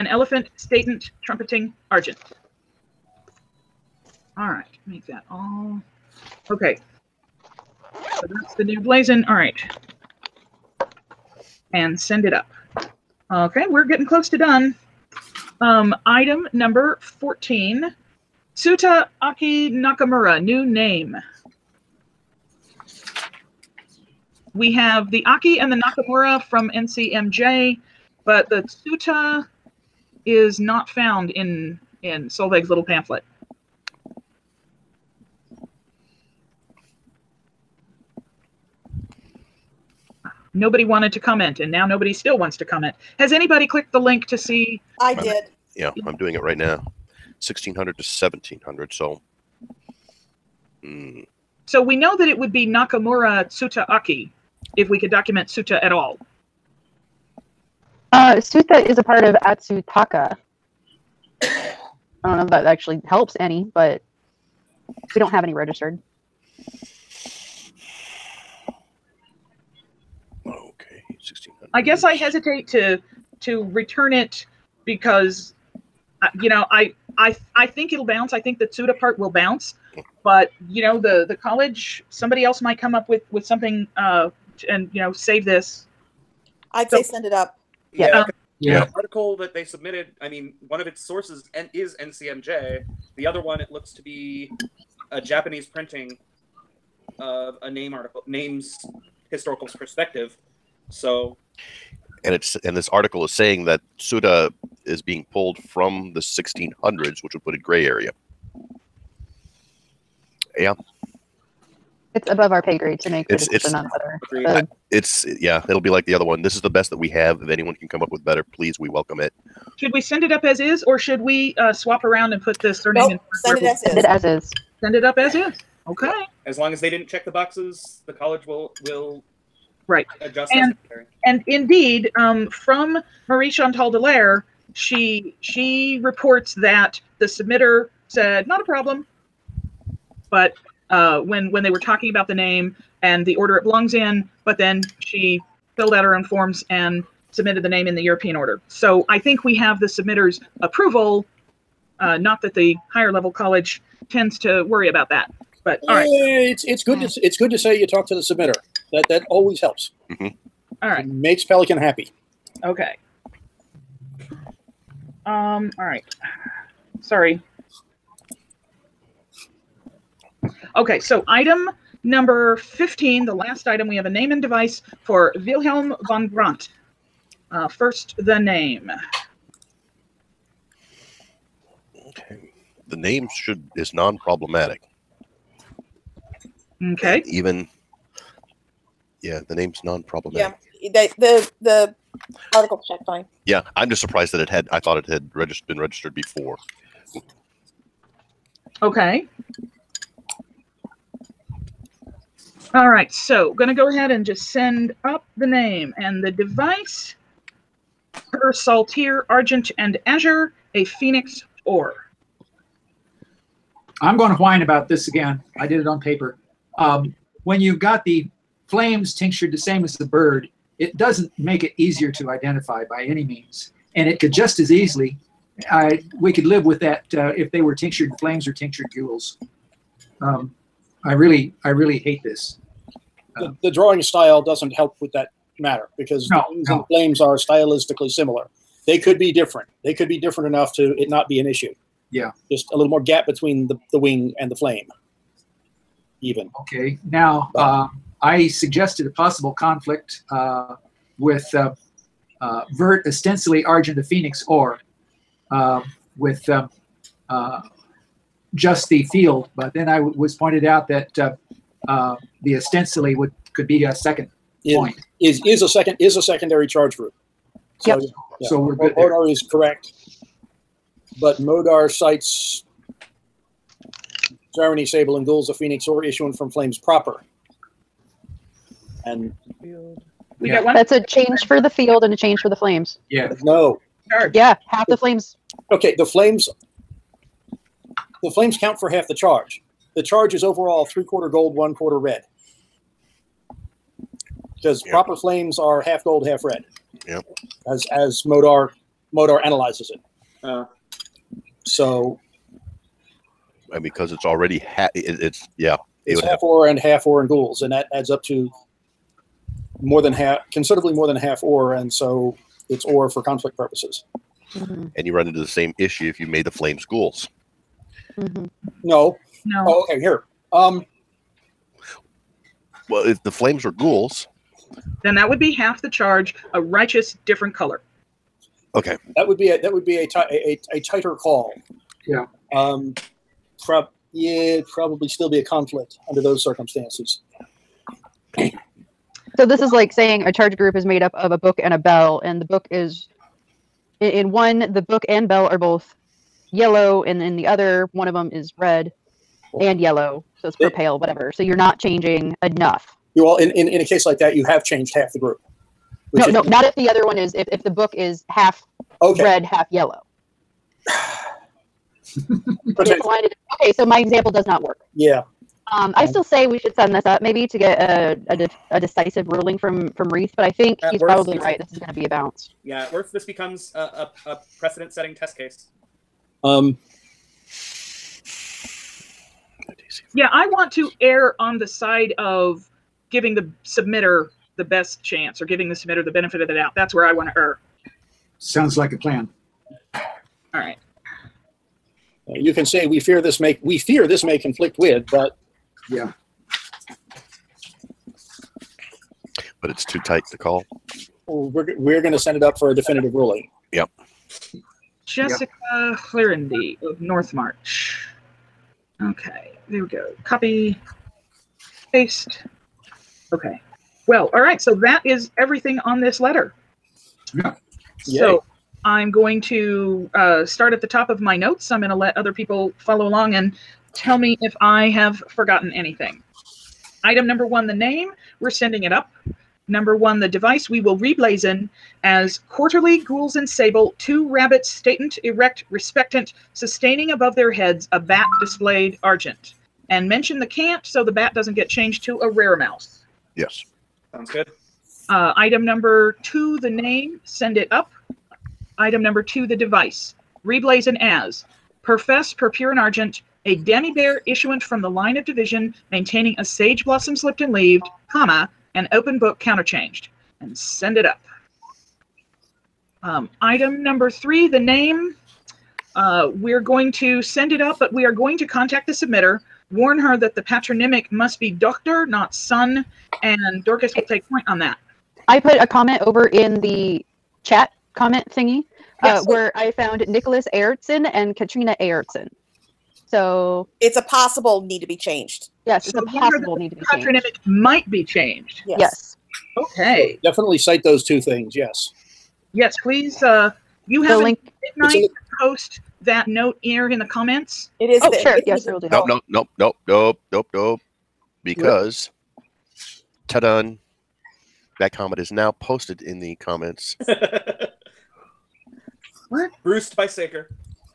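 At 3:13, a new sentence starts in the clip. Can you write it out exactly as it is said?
Yeah, I'm just surprised that it had.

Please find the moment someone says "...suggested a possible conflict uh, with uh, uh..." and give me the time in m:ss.
4:08.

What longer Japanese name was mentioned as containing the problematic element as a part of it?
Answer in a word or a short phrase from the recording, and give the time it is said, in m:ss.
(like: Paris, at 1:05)
Atsutaka, at 0:59.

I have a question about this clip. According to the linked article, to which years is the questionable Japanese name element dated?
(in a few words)
1600 to 1700.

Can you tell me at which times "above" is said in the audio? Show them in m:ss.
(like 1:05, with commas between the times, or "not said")
1:52, 7:17.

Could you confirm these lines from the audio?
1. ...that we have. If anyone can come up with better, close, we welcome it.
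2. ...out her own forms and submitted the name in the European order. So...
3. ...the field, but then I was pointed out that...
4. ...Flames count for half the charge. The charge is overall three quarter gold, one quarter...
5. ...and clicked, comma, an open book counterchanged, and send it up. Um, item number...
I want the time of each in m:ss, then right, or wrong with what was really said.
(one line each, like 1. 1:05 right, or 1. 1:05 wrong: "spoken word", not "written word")
1. 1:56 wrong: "please", not "close"
2. 2:25 right
3. 4:18 right
4. 4:48 right
5. 7:37 wrong: "leaved", not "clicked".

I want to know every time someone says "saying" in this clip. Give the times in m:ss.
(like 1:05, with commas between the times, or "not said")
1:43, 5:39.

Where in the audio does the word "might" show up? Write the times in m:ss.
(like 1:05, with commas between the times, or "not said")
1:22, 8:07.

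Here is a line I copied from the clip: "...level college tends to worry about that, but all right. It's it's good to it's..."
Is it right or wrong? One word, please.
right.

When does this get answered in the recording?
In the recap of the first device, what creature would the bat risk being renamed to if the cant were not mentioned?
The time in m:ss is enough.
7:22.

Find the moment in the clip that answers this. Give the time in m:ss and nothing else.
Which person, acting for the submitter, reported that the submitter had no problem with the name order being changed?
2:13.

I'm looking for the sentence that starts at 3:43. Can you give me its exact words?
And it could just as easily I, we could live with that uh, if they were tinctured flames or tinctured jewels.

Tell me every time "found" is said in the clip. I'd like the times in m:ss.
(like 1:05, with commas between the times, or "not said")
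0:30, 7:59.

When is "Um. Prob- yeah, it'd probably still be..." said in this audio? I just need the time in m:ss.
5:32.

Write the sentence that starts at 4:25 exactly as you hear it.
Is is a second is a secondary charge group.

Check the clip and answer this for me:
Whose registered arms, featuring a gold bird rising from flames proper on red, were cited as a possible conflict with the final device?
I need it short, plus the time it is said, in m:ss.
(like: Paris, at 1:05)
Jeremy Sable, at 4:34.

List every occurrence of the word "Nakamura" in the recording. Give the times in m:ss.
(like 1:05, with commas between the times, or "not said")
0:19, 0:25, 0:52.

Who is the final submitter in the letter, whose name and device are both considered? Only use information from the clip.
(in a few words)
Wilhelm von Brandt.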